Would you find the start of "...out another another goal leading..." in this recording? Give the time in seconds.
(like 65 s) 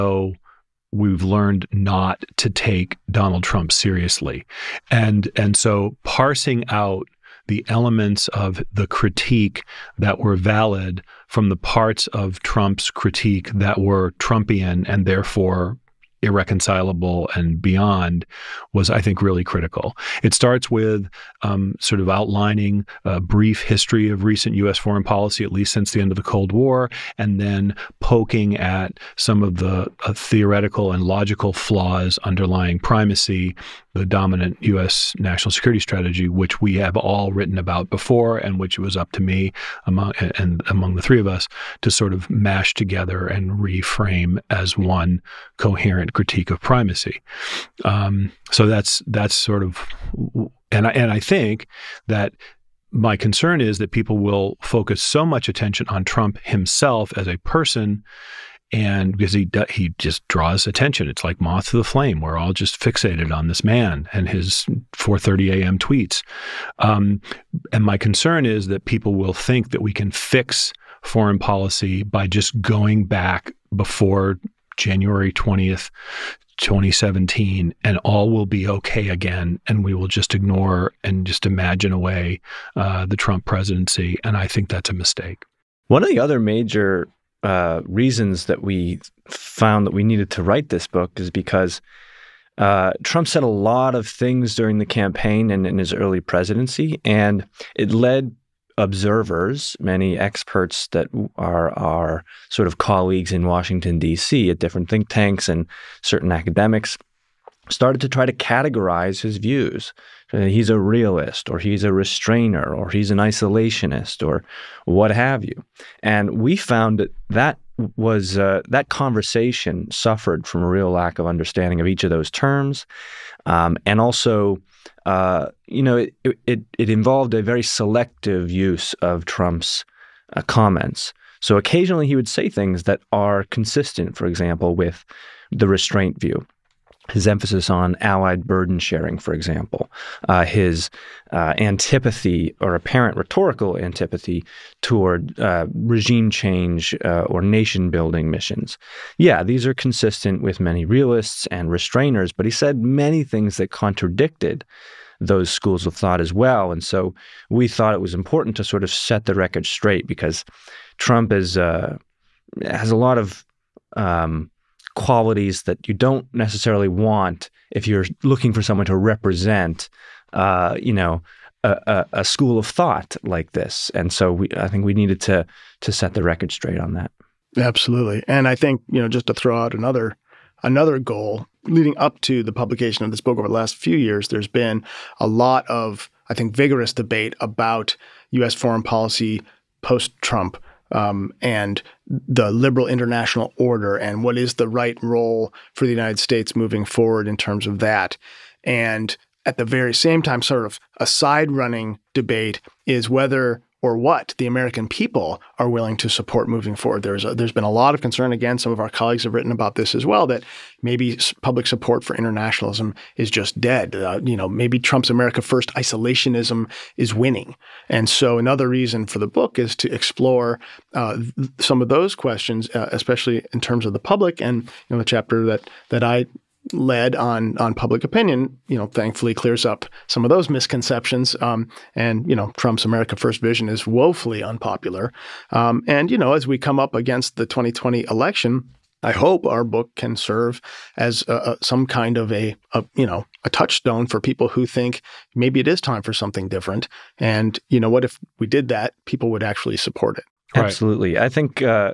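179 s.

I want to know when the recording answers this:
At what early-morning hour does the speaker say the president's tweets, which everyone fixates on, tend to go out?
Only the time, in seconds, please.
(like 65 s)
64 s.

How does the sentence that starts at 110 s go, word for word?
He's a realist, or he's a restrainer, or he's an isolationist, or what have you.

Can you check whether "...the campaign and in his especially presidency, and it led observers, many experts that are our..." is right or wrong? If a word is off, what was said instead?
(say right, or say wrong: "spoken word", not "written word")
wrong: "early", not "especially".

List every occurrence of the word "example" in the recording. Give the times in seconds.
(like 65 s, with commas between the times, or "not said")
134 s, 139 s.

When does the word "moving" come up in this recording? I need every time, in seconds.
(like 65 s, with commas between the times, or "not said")
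196 s, 206 s.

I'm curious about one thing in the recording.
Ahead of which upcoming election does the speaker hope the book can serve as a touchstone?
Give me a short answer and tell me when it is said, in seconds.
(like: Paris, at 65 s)
2020 election, at 237 s.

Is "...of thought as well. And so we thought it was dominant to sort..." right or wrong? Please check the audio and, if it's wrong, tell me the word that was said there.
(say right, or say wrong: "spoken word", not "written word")
wrong: "important", not "dominant".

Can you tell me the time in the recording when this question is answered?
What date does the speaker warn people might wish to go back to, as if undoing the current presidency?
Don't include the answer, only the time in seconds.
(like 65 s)
74 s.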